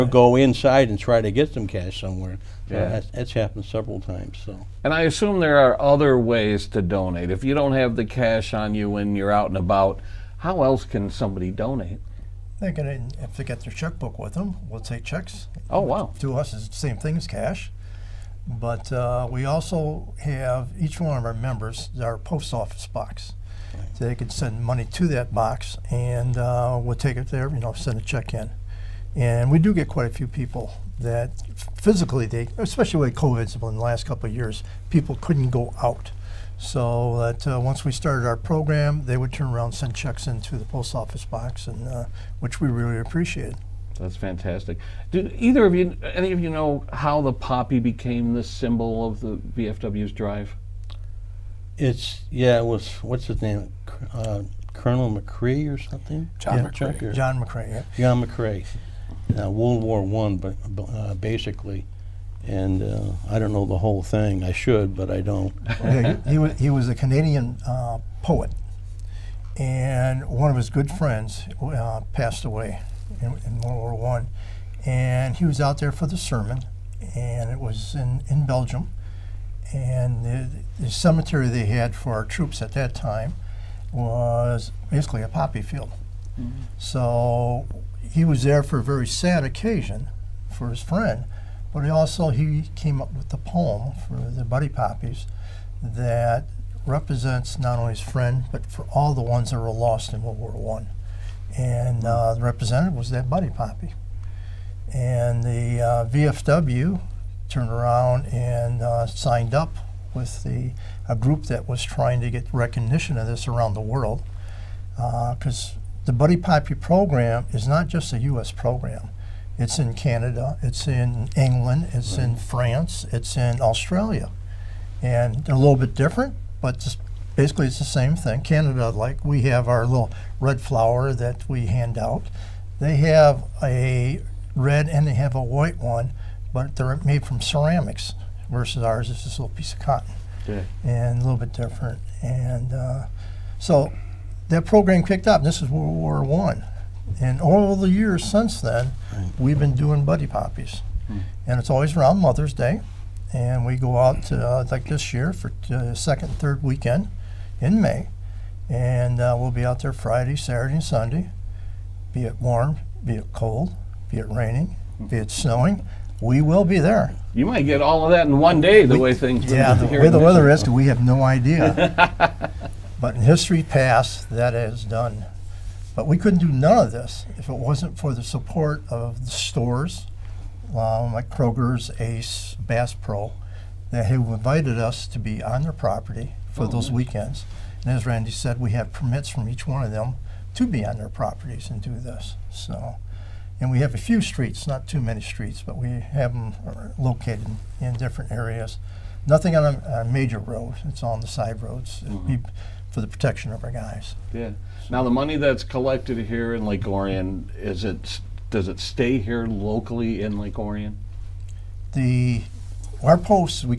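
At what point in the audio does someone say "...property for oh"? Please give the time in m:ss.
3:05.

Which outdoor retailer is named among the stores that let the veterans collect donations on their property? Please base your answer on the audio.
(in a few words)
Bass Pro.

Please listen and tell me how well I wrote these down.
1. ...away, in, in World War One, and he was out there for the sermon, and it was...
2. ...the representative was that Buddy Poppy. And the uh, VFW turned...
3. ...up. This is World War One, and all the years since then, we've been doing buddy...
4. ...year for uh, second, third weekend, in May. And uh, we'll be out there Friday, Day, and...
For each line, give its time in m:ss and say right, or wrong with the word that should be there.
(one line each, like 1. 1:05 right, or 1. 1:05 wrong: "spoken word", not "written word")
1. 1:12 right
2. 1:42 right
3. 2:25 right
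4. 2:35 wrong: "Saturday", not "Day".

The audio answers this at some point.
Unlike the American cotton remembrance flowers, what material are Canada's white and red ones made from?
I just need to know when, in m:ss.
2:17.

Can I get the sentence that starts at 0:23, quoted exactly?
So they can send money to that box, and uh, we'll take it there.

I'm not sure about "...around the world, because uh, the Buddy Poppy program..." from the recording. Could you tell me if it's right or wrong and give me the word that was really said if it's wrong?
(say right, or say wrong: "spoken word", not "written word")
right.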